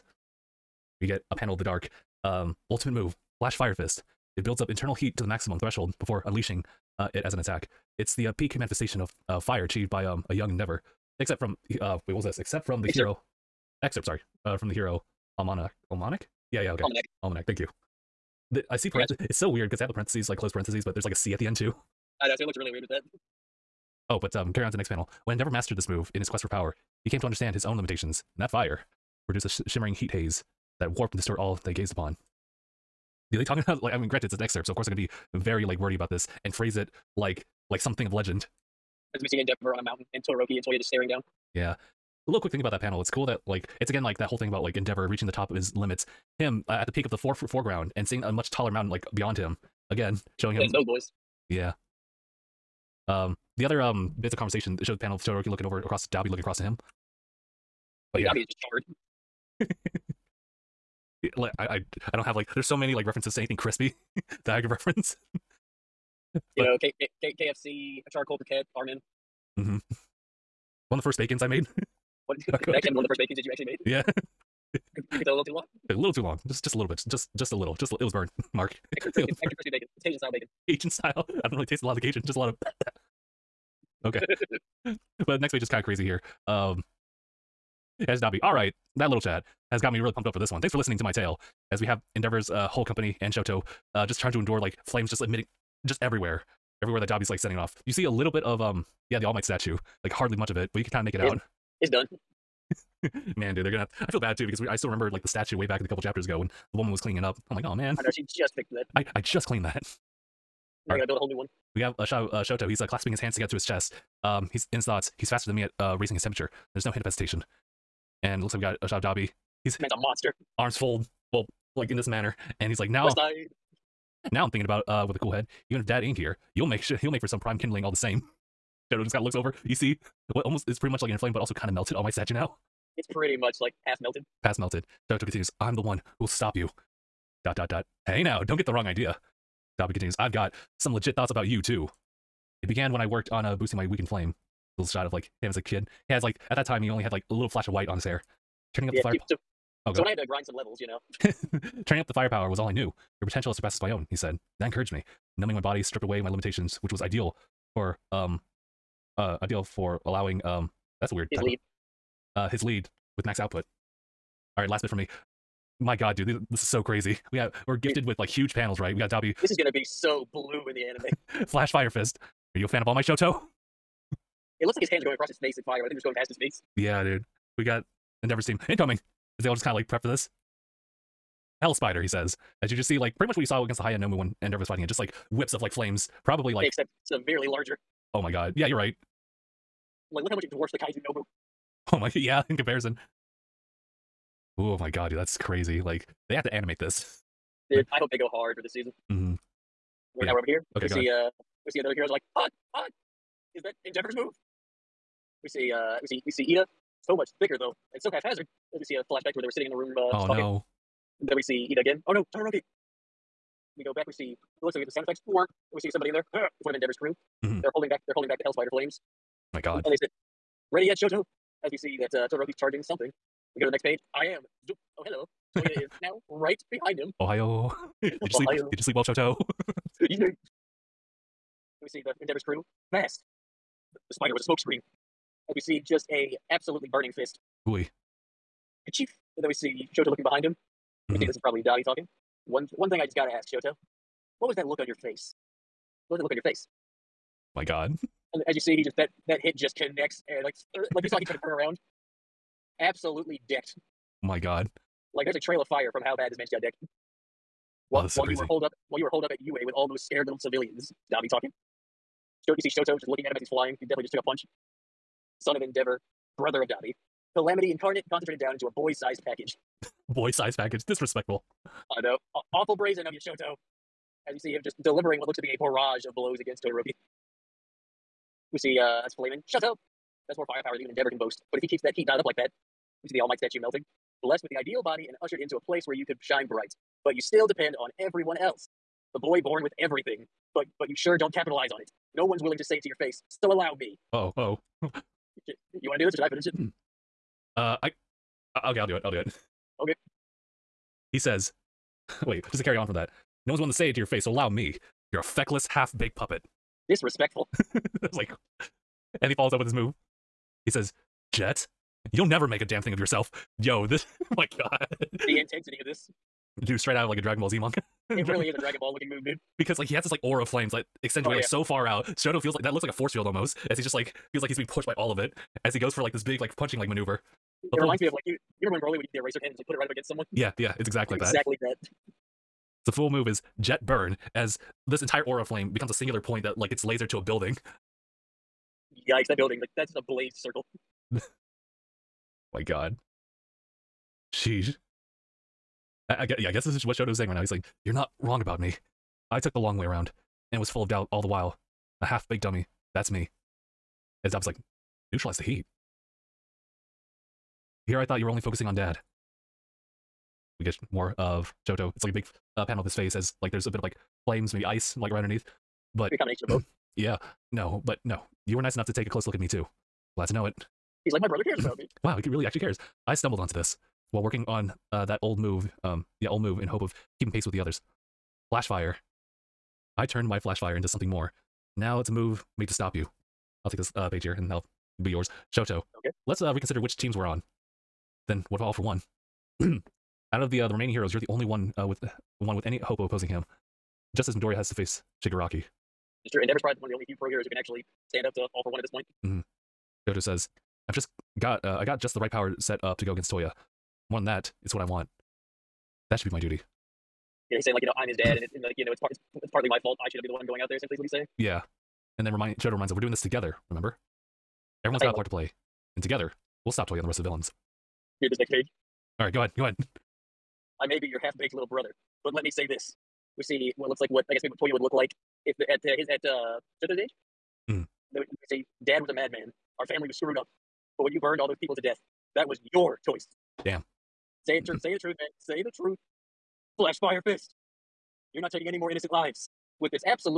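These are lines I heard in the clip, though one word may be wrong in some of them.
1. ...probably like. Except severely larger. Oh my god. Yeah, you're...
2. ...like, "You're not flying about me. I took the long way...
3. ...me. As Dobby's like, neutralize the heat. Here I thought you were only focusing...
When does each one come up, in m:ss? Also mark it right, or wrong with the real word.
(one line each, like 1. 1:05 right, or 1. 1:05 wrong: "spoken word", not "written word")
1. 3:06 right
2. 5:47 wrong: "wrong", not "flying"
3. 5:53 right.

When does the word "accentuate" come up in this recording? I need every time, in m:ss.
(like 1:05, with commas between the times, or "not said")
5:21.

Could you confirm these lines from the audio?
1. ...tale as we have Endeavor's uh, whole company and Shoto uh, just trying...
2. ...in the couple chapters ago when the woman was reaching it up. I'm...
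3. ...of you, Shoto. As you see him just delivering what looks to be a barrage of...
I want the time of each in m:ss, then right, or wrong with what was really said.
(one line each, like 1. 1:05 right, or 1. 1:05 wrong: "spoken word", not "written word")
1. 1:31 right
2. 1:45 wrong: "cleaning", not "reaching"
3. 4:33 right.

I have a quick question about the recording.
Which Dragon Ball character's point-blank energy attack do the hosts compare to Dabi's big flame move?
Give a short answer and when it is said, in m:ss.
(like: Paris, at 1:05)
Broly, at 5:28.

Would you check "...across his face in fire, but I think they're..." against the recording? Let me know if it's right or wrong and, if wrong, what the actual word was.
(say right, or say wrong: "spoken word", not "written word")
right.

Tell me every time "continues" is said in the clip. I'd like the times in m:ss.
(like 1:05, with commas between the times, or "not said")
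2:15, 2:19.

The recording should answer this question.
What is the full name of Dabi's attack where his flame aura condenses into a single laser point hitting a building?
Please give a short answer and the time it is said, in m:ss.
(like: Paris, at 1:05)
Jet Burn, at 5:32.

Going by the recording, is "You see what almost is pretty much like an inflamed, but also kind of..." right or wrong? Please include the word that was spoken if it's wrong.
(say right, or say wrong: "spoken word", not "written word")
right.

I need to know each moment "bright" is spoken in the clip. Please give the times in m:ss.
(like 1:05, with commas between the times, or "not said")
4:46.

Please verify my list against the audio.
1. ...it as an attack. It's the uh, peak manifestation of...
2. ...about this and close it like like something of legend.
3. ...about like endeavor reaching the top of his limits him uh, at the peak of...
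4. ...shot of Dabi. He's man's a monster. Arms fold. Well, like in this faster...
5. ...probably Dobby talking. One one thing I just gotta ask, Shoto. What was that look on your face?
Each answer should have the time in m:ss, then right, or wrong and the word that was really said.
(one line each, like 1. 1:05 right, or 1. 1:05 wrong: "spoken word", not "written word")
1. 0:07 right
2. 0:35 wrong: "phrase", not "close"
3. 0:44 right
4. 1:58 wrong: "manner", not "faster"
5. 4:01 right.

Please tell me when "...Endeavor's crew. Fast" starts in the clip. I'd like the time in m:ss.
3:52.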